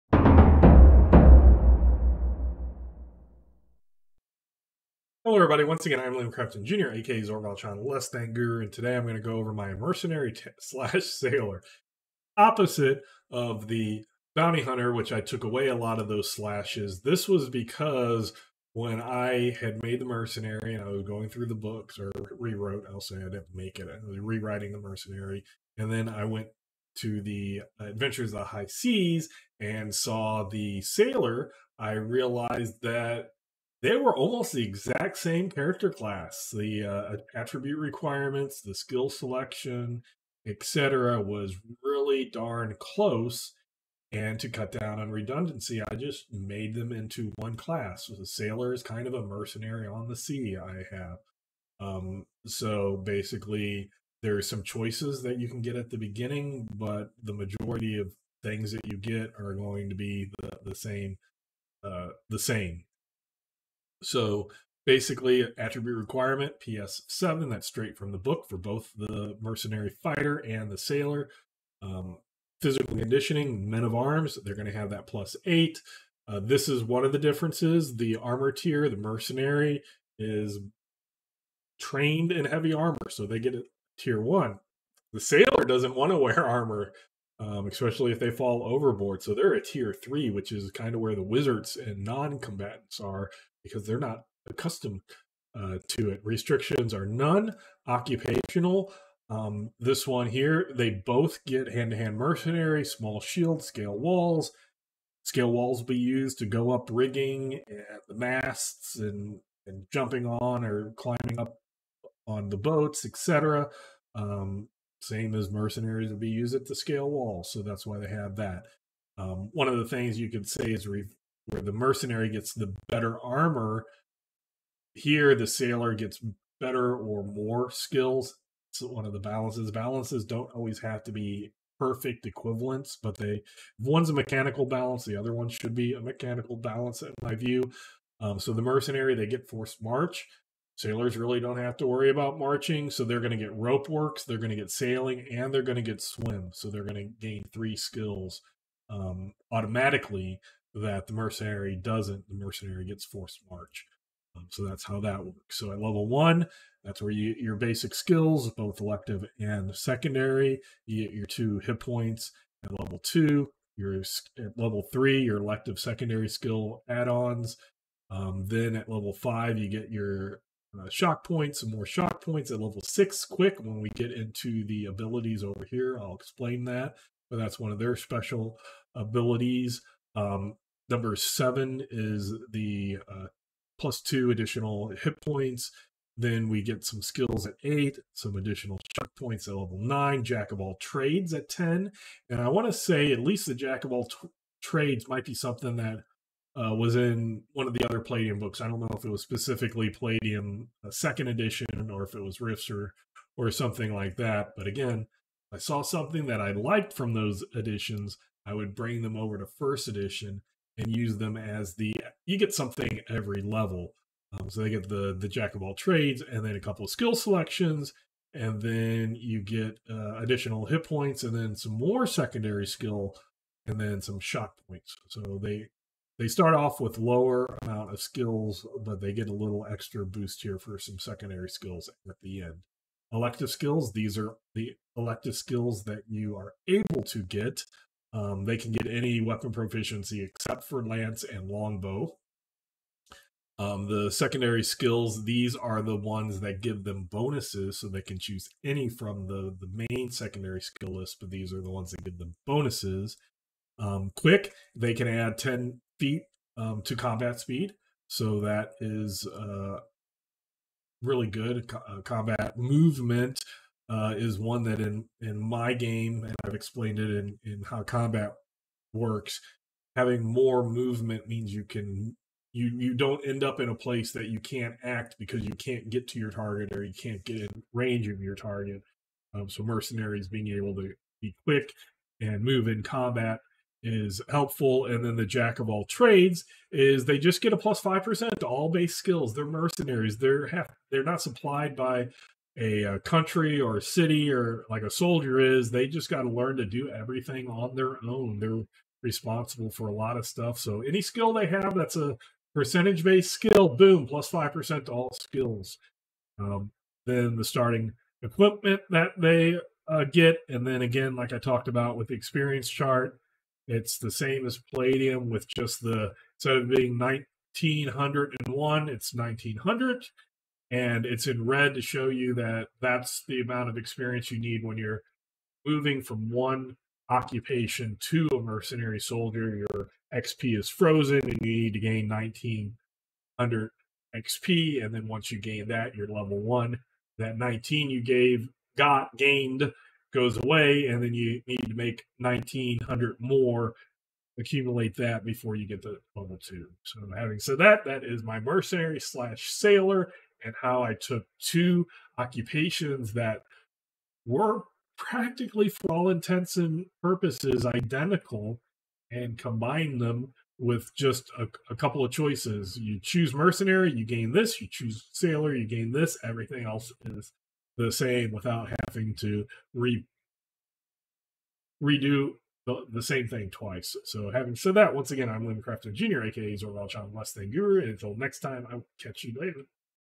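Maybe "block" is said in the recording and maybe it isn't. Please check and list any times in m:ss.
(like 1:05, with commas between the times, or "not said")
not said.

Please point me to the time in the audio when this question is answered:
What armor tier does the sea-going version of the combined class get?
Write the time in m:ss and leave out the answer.
1:29.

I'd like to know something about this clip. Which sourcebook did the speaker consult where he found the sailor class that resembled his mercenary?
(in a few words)
Adventures of the High Seas.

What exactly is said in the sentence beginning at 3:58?
Um, they can get any weapon proficiency except for lance and longbow.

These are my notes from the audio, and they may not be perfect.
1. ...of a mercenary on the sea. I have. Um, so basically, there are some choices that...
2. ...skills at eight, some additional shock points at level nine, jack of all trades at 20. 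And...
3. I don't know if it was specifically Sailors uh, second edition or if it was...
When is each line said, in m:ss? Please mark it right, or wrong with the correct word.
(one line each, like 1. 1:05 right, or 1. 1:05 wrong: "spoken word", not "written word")
1. 0:49 right
2. 3:07 wrong: "10", not "20"
3. 3:18 wrong: "Palladium", not "Sailors".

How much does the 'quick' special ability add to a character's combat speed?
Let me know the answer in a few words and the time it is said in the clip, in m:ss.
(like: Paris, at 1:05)
10, at 4:15.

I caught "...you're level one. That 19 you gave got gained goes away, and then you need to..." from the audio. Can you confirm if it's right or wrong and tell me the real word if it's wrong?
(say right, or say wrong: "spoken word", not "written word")
right.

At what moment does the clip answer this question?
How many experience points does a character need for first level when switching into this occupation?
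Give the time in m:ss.
5:32.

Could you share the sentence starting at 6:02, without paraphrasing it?
You choose mercenary, you gain this.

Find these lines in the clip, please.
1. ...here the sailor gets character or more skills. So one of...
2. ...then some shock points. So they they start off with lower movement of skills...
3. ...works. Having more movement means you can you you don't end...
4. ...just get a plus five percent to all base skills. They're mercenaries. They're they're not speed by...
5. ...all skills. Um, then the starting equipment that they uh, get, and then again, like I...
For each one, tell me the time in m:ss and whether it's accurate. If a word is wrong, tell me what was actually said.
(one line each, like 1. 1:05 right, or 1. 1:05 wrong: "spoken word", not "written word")
1. 2:04 wrong: "better", not "character"
2. 3:43 wrong: "amount", not "movement"
3. 4:28 right
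4. 4:47 wrong: "supplied", not "speed"
5. 5:04 right.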